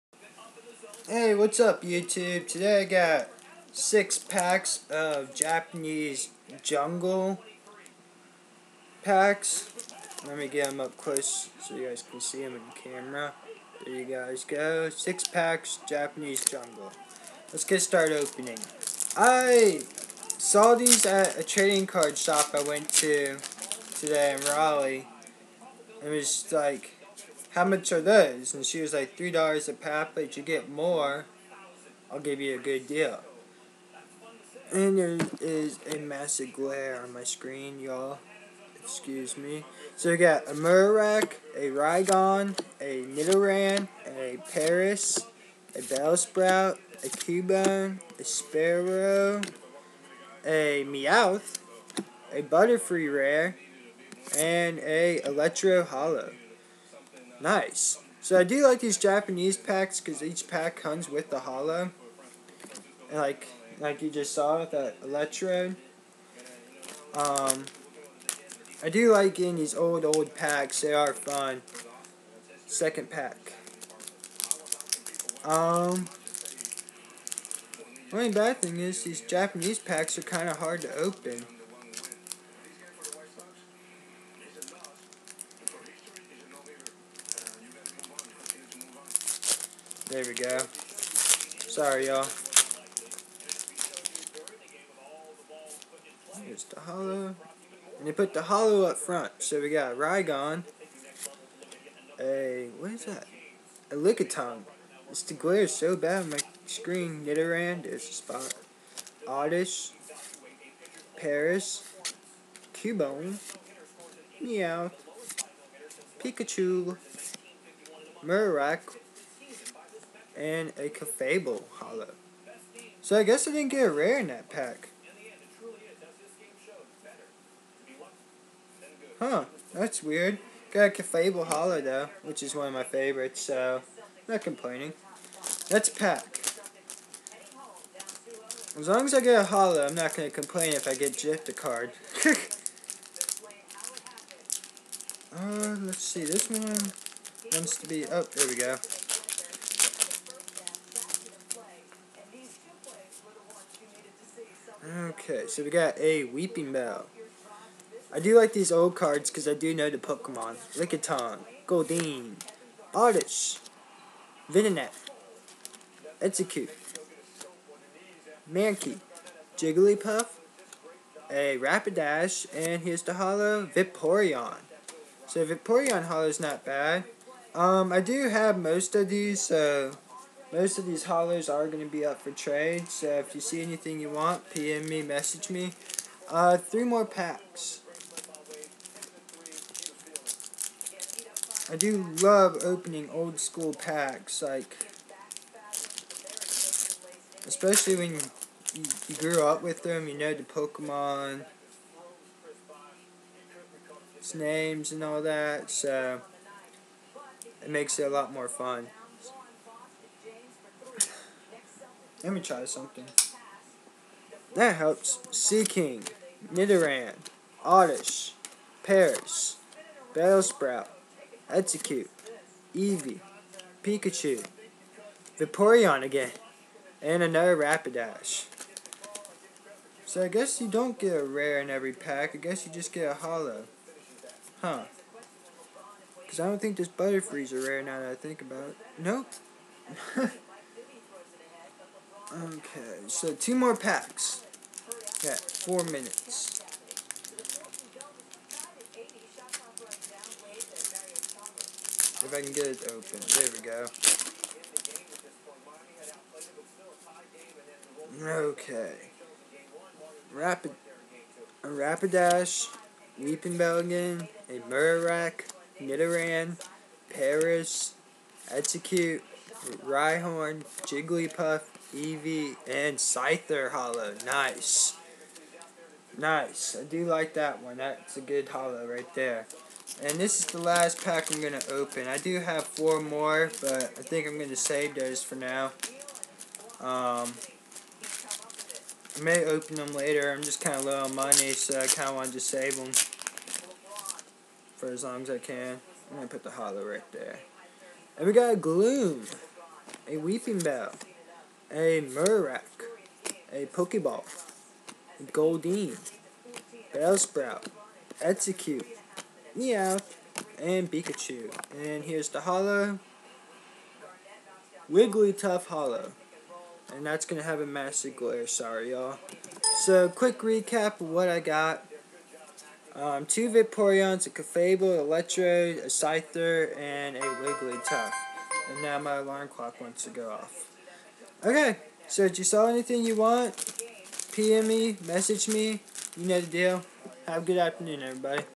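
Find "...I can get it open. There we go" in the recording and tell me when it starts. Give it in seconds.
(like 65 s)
252 s.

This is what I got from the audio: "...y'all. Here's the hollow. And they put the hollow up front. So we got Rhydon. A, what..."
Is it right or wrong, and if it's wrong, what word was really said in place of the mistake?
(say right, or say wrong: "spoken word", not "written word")
right.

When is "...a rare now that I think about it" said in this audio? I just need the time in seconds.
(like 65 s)
237 s.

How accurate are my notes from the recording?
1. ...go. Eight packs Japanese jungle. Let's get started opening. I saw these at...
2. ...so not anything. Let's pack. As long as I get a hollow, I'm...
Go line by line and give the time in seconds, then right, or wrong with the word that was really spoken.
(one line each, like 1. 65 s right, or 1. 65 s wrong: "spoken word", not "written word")
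1. 14 s wrong: "Six", not "Eight"
2. 133 s wrong: "complaining", not "anything".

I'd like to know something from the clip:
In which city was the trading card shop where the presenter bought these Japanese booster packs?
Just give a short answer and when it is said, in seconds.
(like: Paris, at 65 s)
Raleigh, at 24 s.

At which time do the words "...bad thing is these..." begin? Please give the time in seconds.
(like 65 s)
78 s.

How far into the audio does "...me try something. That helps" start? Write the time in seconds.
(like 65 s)
212 s.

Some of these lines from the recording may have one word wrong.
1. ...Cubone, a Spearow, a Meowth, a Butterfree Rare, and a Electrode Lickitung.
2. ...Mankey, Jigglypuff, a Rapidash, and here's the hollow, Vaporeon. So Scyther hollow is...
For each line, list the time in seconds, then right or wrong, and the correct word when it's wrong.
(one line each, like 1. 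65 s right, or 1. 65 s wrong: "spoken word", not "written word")
1. 47 s wrong: "Hollow", not "Lickitung"
2. 168 s wrong: "Vaporeon", not "Scyther".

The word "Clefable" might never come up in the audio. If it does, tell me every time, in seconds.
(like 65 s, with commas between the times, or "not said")
120 s, 130 s, 324 s.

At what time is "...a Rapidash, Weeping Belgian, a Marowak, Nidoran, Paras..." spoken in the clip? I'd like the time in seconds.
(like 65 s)
261 s.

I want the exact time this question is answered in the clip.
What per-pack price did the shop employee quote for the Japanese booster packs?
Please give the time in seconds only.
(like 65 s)
29 s.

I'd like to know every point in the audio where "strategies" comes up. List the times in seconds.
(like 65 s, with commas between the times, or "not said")
not said.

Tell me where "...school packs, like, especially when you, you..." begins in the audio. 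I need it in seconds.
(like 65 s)
193 s.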